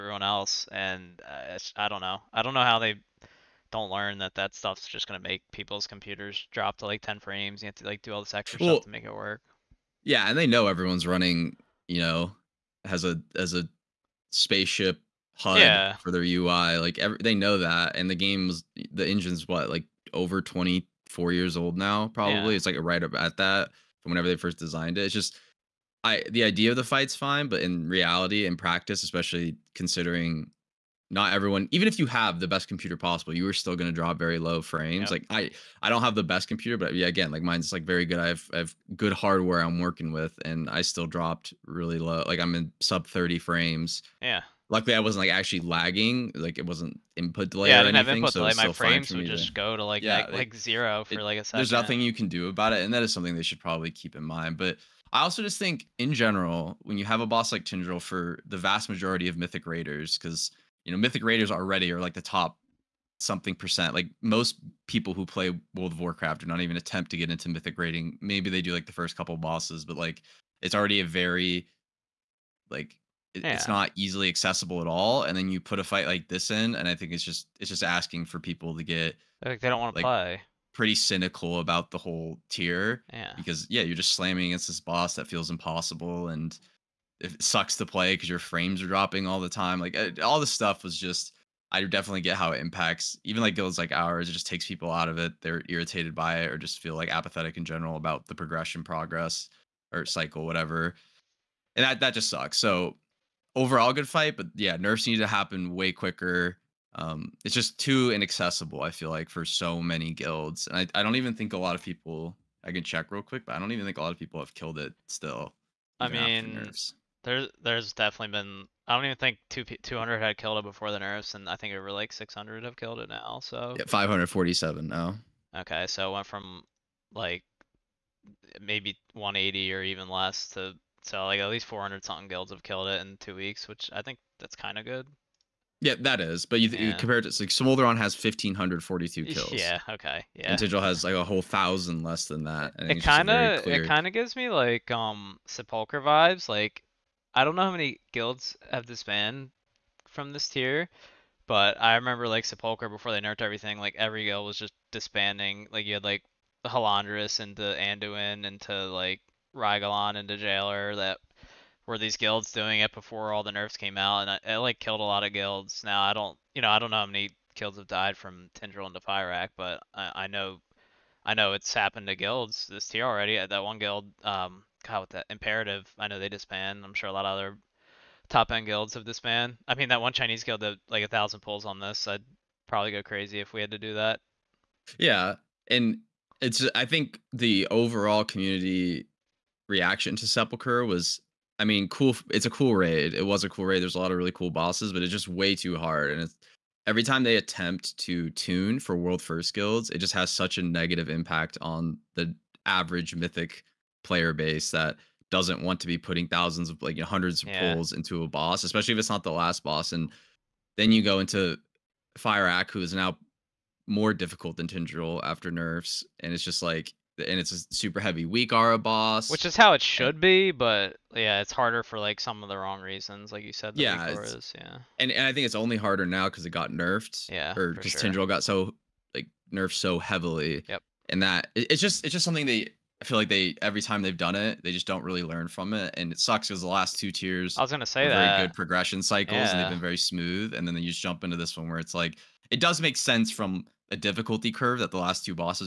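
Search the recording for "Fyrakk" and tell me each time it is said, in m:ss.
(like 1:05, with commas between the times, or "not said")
2:49, 3:32.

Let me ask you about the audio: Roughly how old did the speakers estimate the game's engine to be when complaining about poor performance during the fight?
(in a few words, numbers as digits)
24 years.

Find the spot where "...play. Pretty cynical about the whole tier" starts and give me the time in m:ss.
1:20.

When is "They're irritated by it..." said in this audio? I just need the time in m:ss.
1:35.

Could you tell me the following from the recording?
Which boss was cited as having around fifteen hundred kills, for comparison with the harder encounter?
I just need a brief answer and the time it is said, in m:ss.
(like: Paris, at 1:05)
Smolderon, at 2:17.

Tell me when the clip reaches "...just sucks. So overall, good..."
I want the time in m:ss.
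1:42.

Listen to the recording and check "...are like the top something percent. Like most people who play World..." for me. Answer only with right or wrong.
right.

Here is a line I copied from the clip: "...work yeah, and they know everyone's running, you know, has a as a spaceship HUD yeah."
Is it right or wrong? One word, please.
right.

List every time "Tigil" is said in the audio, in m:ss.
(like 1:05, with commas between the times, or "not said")
2:20.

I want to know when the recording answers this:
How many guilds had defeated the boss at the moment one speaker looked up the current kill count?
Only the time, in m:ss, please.
2:03.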